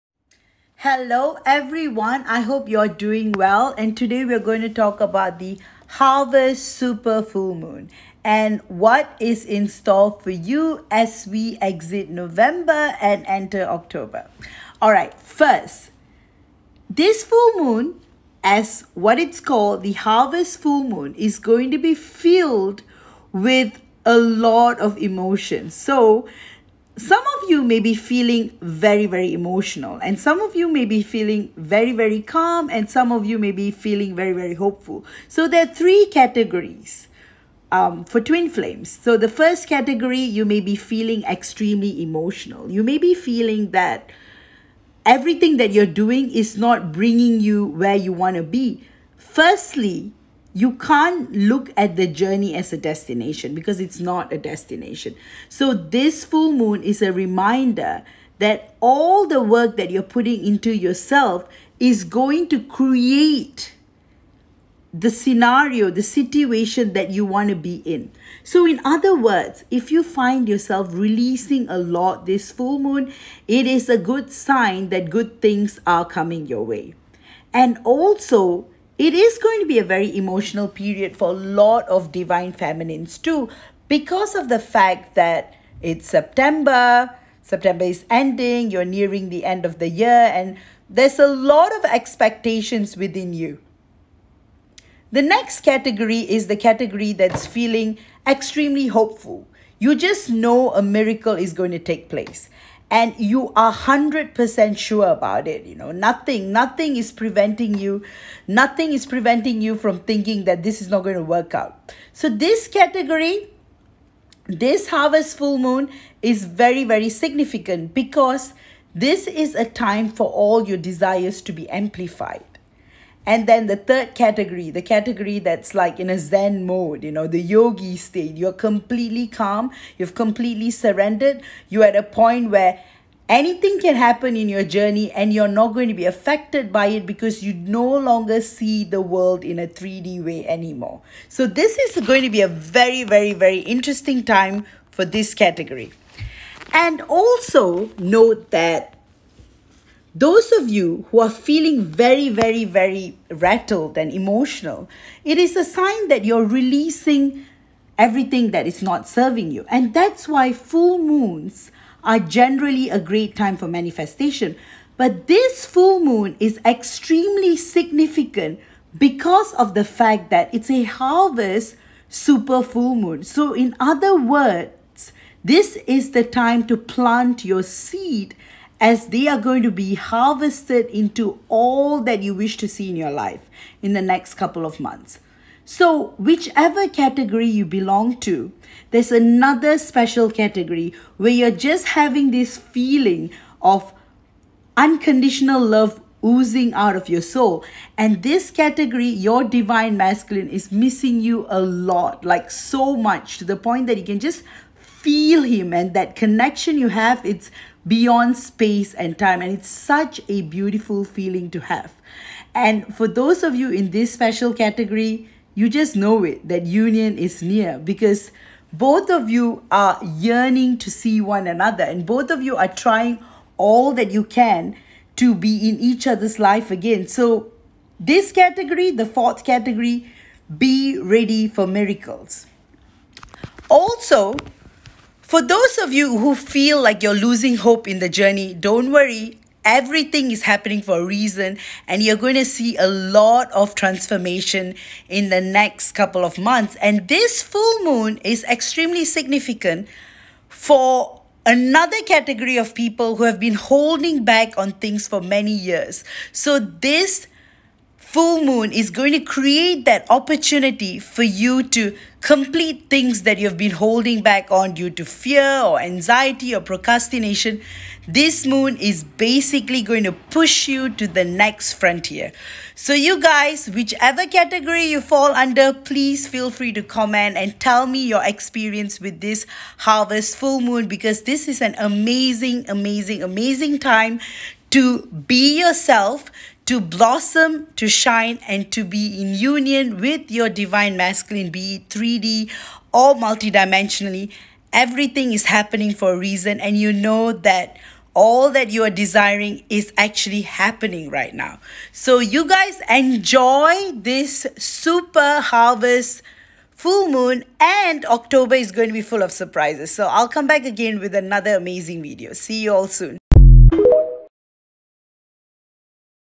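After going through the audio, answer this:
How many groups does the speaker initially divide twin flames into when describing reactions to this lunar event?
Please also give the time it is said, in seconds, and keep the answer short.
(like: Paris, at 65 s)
3, at 35 s.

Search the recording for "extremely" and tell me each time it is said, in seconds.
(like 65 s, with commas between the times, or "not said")
41 s, 98 s, 166 s, 248 s.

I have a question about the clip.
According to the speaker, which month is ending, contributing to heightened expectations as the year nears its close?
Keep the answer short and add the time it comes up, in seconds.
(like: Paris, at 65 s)
September, at 87 s.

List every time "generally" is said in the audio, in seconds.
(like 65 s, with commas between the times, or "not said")
162 s.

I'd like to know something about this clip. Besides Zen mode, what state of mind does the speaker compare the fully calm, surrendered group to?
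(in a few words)
the yogi state.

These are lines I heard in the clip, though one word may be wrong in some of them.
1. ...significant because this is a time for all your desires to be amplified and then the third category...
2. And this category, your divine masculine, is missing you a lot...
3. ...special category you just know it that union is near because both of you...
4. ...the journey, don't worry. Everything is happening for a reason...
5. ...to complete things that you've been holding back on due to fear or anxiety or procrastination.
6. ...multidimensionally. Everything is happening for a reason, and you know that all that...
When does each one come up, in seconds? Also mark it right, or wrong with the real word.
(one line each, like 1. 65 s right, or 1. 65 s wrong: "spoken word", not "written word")
1. 117 s right
2. 197 s right
3. 214 s right
4. 237 s right
5. 261 s right
6. 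293 s right.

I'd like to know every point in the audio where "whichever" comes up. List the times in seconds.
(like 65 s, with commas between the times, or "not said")
186 s, 273 s.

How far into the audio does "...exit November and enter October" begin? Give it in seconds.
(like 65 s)
11 s.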